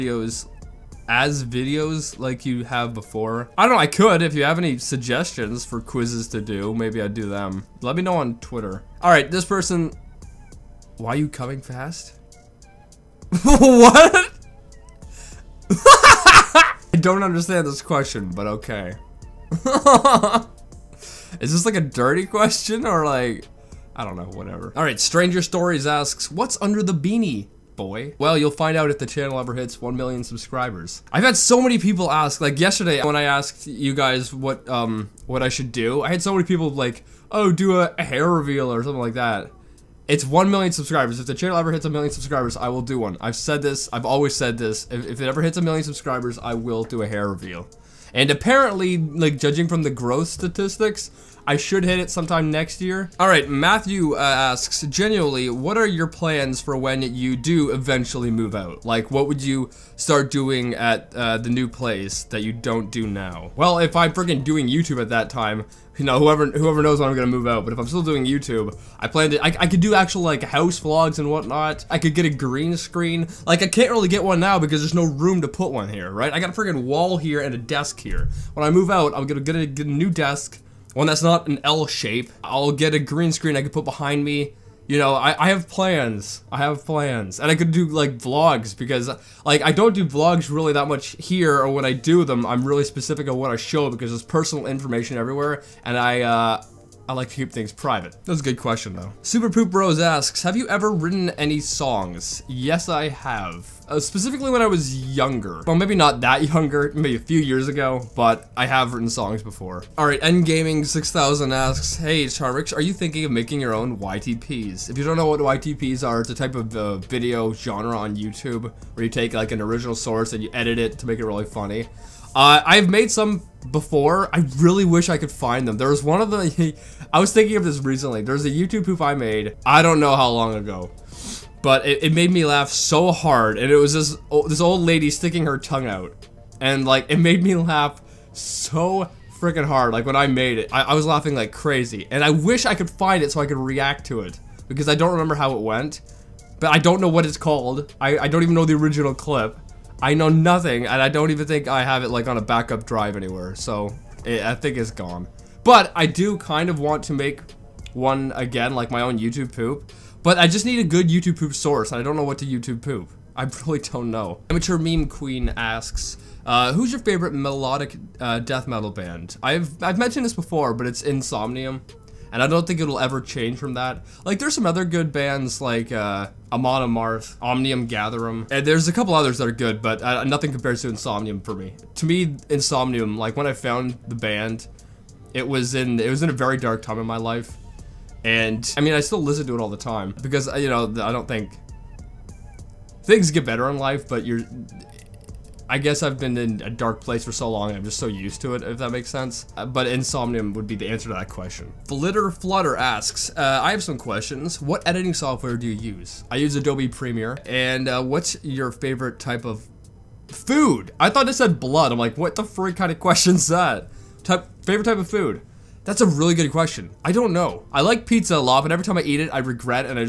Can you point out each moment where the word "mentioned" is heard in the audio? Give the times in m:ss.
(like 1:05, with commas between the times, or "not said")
2:49.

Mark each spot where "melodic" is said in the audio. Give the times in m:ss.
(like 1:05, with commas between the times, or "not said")
2:47.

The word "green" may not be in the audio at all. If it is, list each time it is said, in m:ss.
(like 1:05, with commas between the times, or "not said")
1:12, 1:22.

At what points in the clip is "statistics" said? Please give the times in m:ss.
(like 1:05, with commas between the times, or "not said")
0:50.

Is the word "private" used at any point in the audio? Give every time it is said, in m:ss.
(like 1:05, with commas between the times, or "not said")
1:37.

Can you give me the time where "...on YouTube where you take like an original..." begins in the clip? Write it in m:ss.
1:57.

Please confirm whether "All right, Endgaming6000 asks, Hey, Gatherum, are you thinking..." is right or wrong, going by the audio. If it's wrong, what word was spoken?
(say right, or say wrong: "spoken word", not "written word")
wrong: "Charmx", not "Gatherum".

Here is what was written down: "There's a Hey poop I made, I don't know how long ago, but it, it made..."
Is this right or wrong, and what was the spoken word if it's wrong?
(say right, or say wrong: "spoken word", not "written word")
wrong: "YouTube", not "Hey".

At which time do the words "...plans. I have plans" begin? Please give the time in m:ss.
1:25.